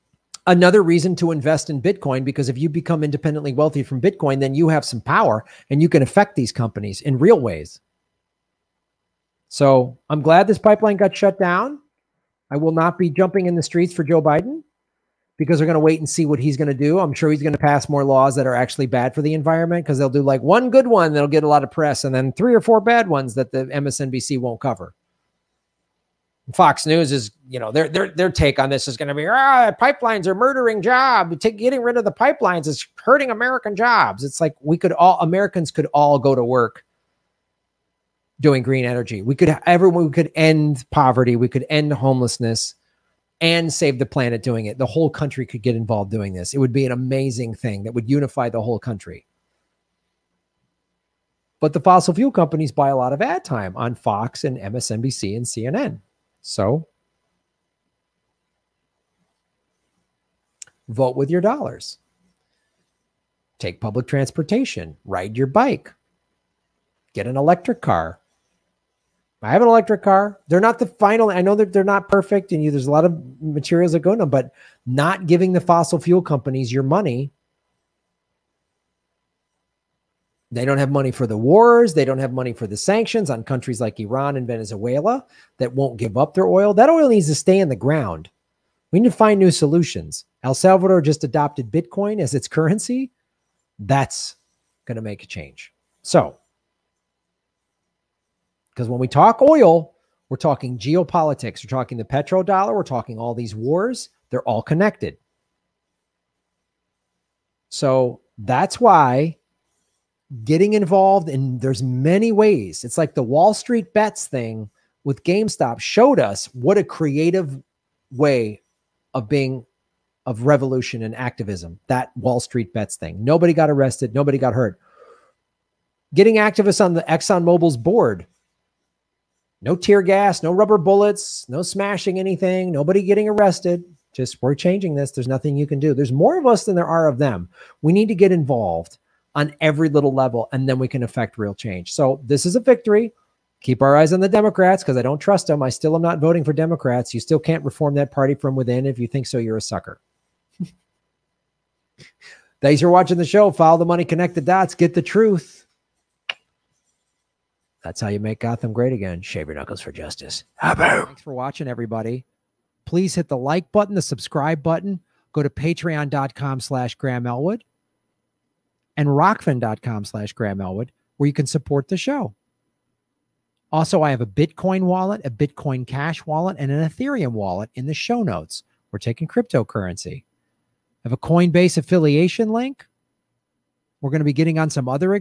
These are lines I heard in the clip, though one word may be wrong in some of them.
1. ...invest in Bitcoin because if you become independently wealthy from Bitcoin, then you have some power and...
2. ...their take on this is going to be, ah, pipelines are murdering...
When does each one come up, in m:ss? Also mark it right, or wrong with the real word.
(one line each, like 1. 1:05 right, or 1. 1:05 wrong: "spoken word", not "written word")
1. 0:01 right
2. 0:28 right.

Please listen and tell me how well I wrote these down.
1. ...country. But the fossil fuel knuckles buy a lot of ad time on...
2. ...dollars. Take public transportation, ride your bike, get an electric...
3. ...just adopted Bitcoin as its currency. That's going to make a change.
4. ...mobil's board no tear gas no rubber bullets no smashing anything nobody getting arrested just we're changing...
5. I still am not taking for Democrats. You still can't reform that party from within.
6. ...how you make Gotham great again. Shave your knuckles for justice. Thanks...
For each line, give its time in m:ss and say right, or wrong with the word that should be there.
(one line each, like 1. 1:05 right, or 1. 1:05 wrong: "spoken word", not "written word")
1. 0:48 wrong: "companies", not "knuckles"
2. 1:01 right
3. 1:31 right
4. 2:07 right
5. 2:25 wrong: "voting", not "taking"
6. 2:38 right.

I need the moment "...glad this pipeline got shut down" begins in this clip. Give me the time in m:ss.
0:10.